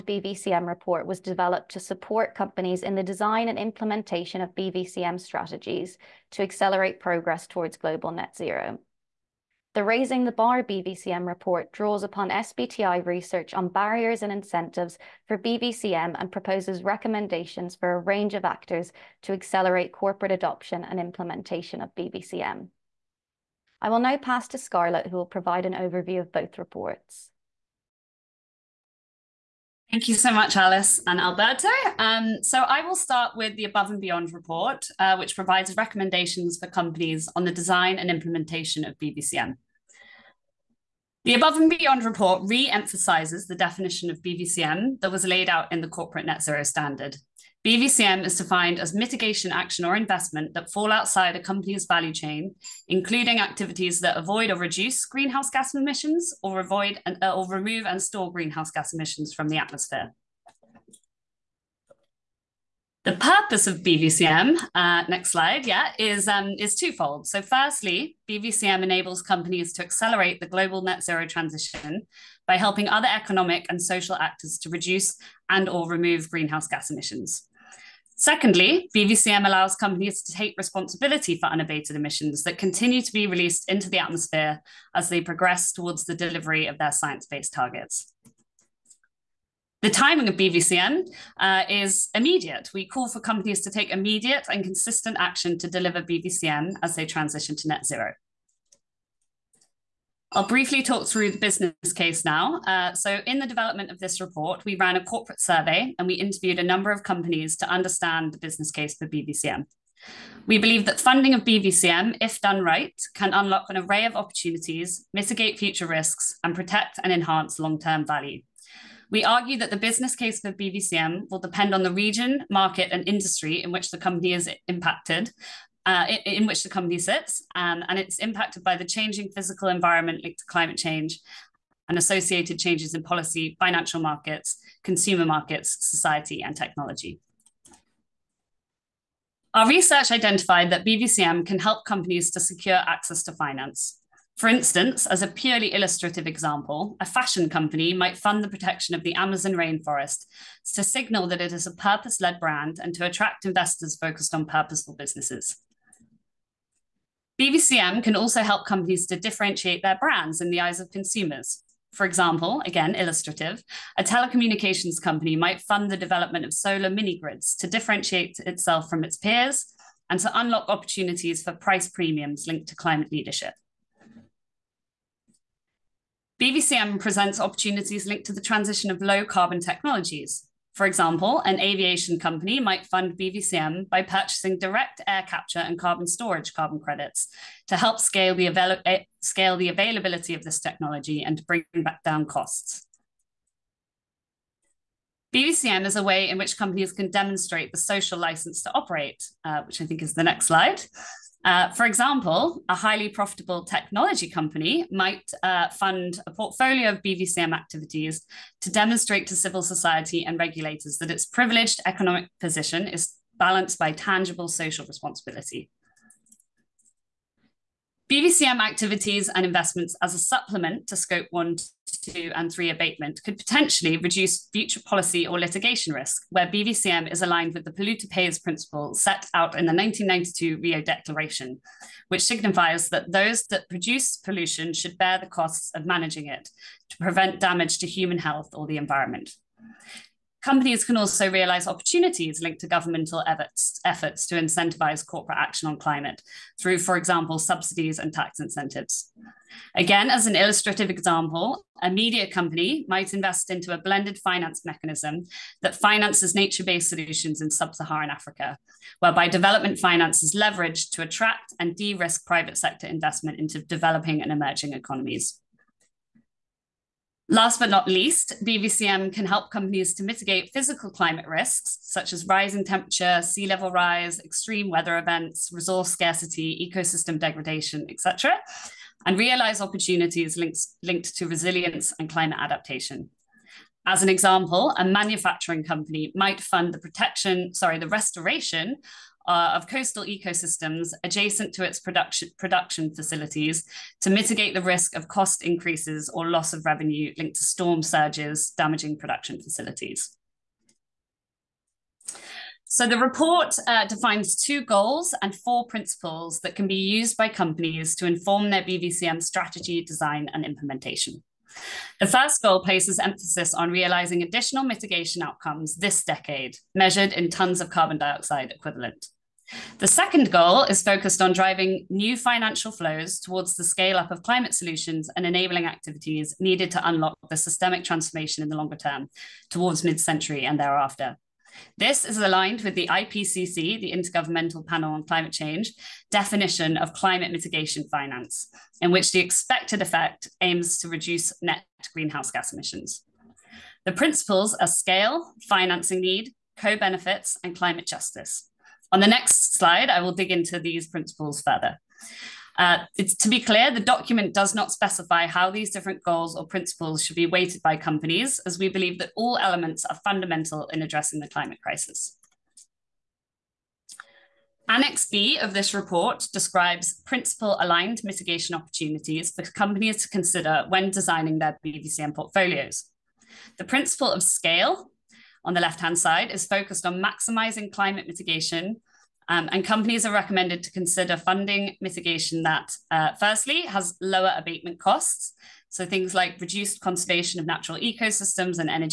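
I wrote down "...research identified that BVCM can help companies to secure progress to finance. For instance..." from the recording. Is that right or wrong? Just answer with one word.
wrong.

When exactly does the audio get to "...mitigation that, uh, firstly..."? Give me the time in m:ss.
6:21.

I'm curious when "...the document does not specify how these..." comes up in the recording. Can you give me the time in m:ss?
5:53.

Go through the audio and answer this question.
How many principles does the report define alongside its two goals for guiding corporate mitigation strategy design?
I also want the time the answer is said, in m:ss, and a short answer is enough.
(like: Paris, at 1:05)
4, at 5:05.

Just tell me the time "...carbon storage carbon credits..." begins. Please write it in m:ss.
3:05.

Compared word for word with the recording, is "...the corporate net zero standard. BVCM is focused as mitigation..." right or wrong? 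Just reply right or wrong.
wrong.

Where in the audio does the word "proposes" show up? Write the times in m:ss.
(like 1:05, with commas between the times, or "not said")
0:16.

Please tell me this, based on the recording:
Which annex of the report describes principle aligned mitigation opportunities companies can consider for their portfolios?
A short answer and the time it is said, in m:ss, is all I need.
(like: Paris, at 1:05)
Annex B, at 6:04.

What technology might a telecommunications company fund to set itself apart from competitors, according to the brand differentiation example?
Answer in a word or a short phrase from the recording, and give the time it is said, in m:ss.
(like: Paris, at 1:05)
solar mini grids, at 2:46.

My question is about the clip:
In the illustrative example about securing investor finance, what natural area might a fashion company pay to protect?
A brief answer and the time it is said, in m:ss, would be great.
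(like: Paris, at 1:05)
Amazon rainforest, at 2:29.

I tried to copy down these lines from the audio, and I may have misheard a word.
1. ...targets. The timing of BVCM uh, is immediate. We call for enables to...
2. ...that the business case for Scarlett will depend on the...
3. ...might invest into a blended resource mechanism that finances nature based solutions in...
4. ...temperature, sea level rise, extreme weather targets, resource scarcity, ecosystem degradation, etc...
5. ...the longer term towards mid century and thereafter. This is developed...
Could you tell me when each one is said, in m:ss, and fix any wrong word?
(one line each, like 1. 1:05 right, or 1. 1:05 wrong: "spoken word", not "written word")
1. 1:27 wrong: "companies", not "enables"
2. 1:59 wrong: "BVCM", not "Scarlett"
3. 4:12 wrong: "finance", not "resource"
4. 4:32 wrong: "events", not "targets"
5. 5:28 wrong: "aligned", not "developed".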